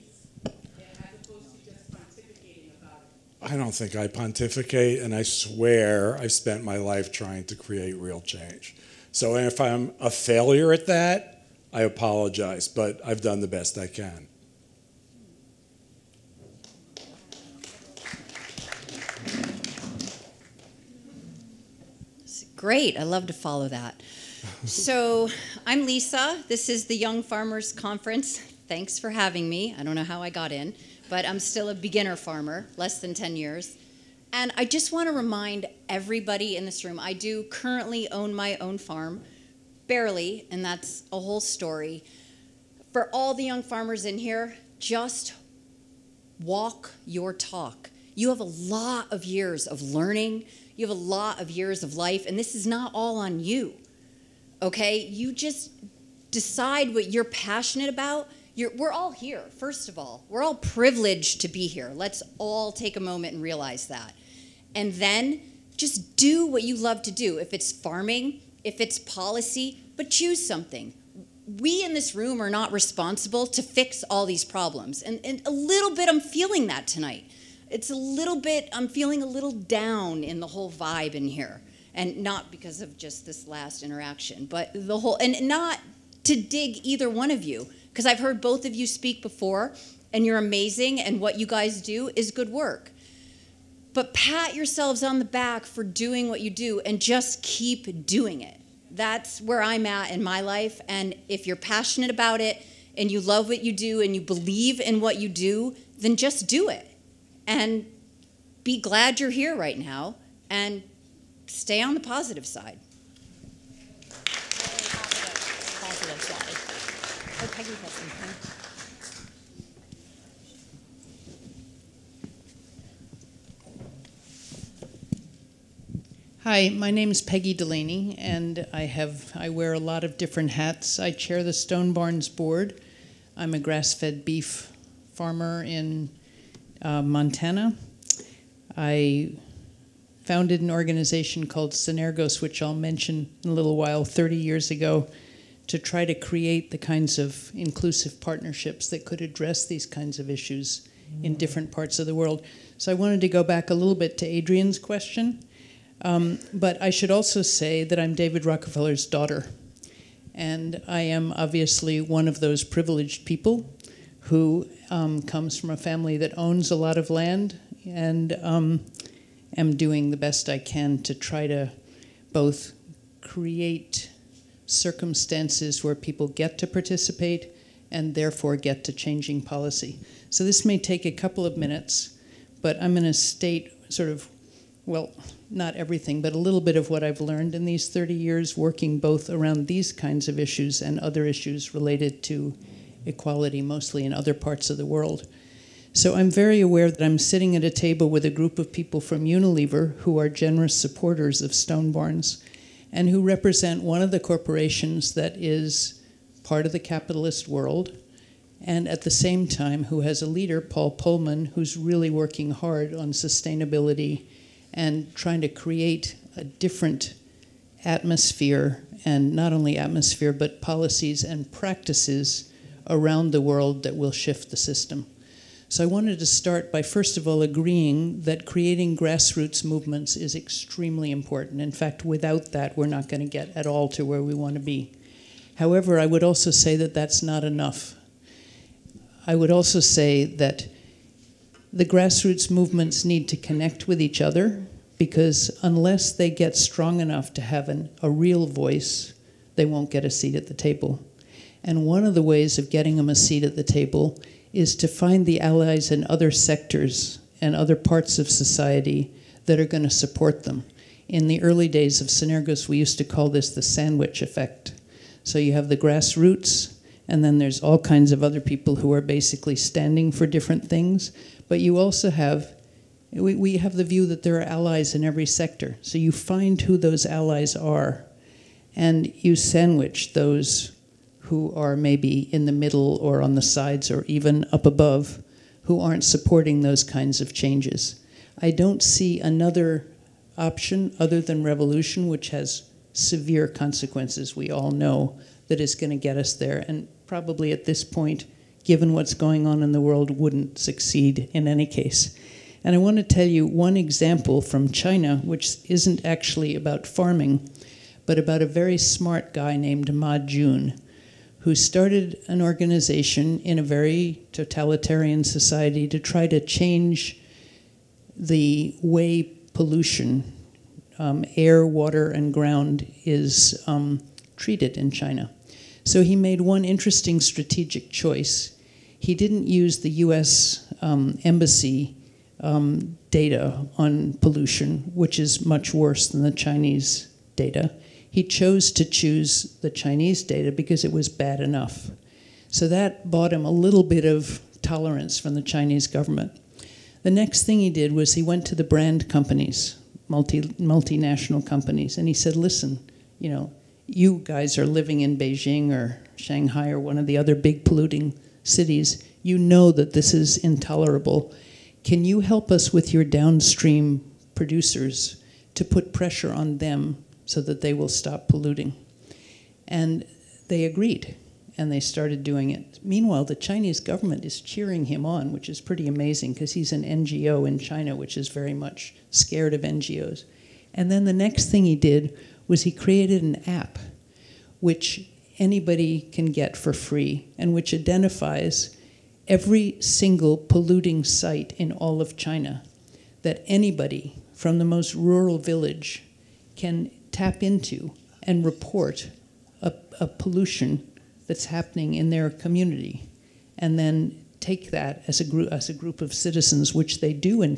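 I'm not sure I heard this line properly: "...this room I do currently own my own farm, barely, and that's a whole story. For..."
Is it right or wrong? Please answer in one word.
right.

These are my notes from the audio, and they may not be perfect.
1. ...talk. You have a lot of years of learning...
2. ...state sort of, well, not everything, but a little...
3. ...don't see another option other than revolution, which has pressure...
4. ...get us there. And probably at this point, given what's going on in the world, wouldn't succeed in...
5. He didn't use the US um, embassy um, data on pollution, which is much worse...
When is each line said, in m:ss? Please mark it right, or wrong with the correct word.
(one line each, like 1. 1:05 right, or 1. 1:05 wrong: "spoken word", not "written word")
1. 0:47 right
2. 3:03 right
3. 4:48 wrong: "severe", not "pressure"
4. 4:55 right
5. 5:28 right.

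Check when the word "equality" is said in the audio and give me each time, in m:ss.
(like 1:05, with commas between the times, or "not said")
3:13.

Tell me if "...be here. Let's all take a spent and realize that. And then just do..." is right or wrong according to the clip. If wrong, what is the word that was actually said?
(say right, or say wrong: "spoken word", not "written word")
wrong: "moment", not "spent".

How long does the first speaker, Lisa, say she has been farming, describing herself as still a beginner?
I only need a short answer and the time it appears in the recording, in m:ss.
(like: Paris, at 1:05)
less than 10 years, at 0:32.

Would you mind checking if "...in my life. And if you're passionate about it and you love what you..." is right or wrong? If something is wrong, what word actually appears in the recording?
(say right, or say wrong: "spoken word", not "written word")
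right.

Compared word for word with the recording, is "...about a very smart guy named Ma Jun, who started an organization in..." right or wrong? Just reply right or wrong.
right.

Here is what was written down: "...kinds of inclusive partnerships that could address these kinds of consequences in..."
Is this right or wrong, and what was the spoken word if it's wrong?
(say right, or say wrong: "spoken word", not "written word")
wrong: "issues", not "consequences".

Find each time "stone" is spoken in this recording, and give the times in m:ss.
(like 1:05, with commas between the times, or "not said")
2:11, 3:21.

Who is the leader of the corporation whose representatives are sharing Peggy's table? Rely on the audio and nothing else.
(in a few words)
Paul Polman.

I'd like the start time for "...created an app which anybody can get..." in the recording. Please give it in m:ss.
6:22.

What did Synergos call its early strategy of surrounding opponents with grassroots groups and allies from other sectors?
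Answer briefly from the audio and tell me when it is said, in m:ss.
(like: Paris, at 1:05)
the sandwich effect, at 4:23.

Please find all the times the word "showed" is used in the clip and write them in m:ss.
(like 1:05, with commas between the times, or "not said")
not said.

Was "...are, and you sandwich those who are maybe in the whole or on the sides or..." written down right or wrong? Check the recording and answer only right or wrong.
wrong.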